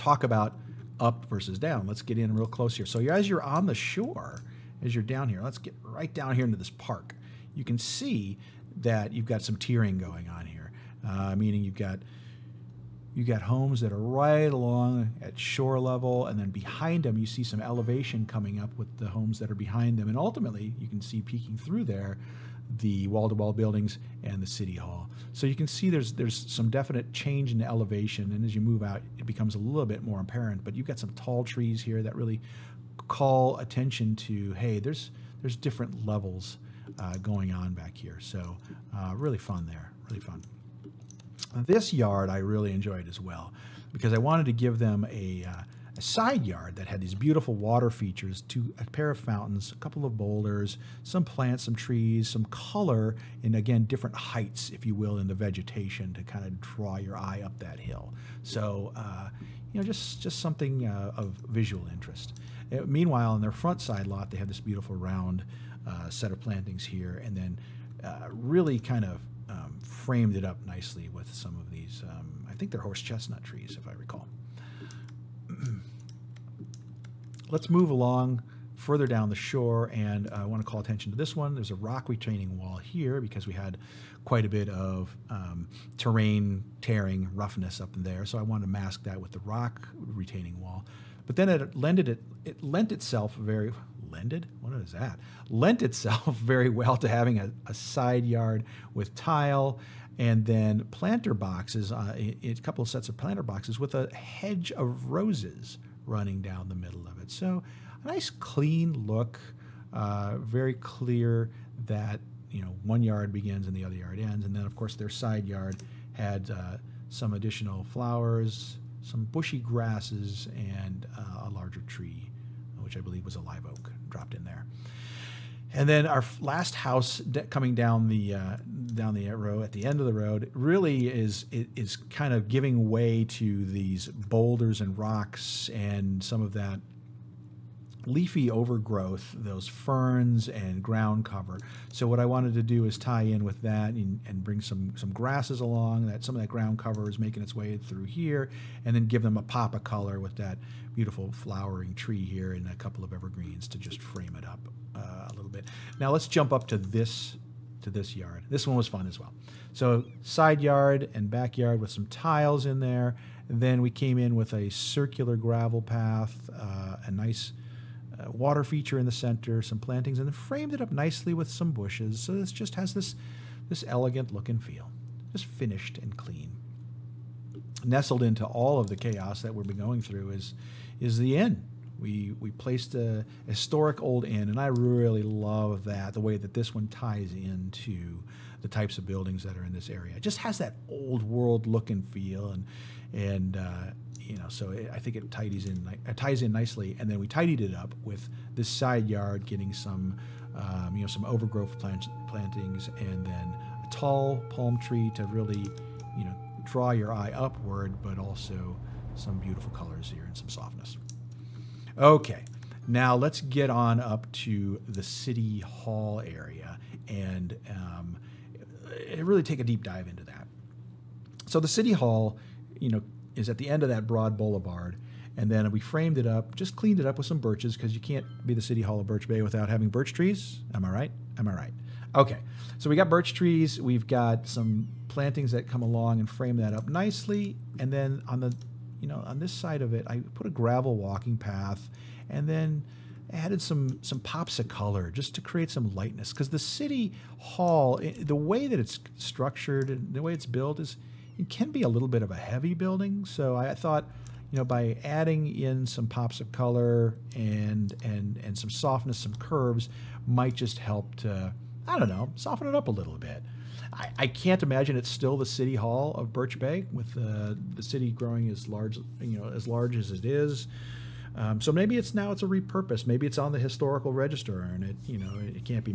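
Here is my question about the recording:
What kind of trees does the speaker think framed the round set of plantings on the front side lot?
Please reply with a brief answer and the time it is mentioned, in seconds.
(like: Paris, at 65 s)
Horse chestnut trees, at 72 s.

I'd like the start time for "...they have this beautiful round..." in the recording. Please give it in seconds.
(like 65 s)
64 s.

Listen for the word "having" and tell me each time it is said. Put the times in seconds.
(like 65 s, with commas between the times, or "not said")
97 s, 229 s.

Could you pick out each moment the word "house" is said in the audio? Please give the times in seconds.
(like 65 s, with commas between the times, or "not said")
126 s.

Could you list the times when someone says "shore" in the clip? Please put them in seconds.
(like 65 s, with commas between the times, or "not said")
3 s, 15 s, 79 s.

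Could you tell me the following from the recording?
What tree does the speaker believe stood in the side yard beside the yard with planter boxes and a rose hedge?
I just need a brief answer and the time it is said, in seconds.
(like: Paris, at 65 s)
Live oak, at 123 s.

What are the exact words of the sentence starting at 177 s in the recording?
Nestled into all of the chaos that we've been going through is, is the inn.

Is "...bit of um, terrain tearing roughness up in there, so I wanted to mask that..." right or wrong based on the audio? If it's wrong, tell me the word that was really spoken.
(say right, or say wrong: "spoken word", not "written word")
right.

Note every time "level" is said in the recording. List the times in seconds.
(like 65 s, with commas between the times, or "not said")
15 s, 36 s.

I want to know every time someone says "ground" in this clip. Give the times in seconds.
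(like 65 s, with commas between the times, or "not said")
140 s, 146 s.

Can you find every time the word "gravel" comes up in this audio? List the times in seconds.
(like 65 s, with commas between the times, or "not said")
165 s, 240 s.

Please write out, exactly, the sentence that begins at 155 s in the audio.
Now let's jump up to this to this yard.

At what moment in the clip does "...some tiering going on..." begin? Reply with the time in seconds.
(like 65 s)
9 s.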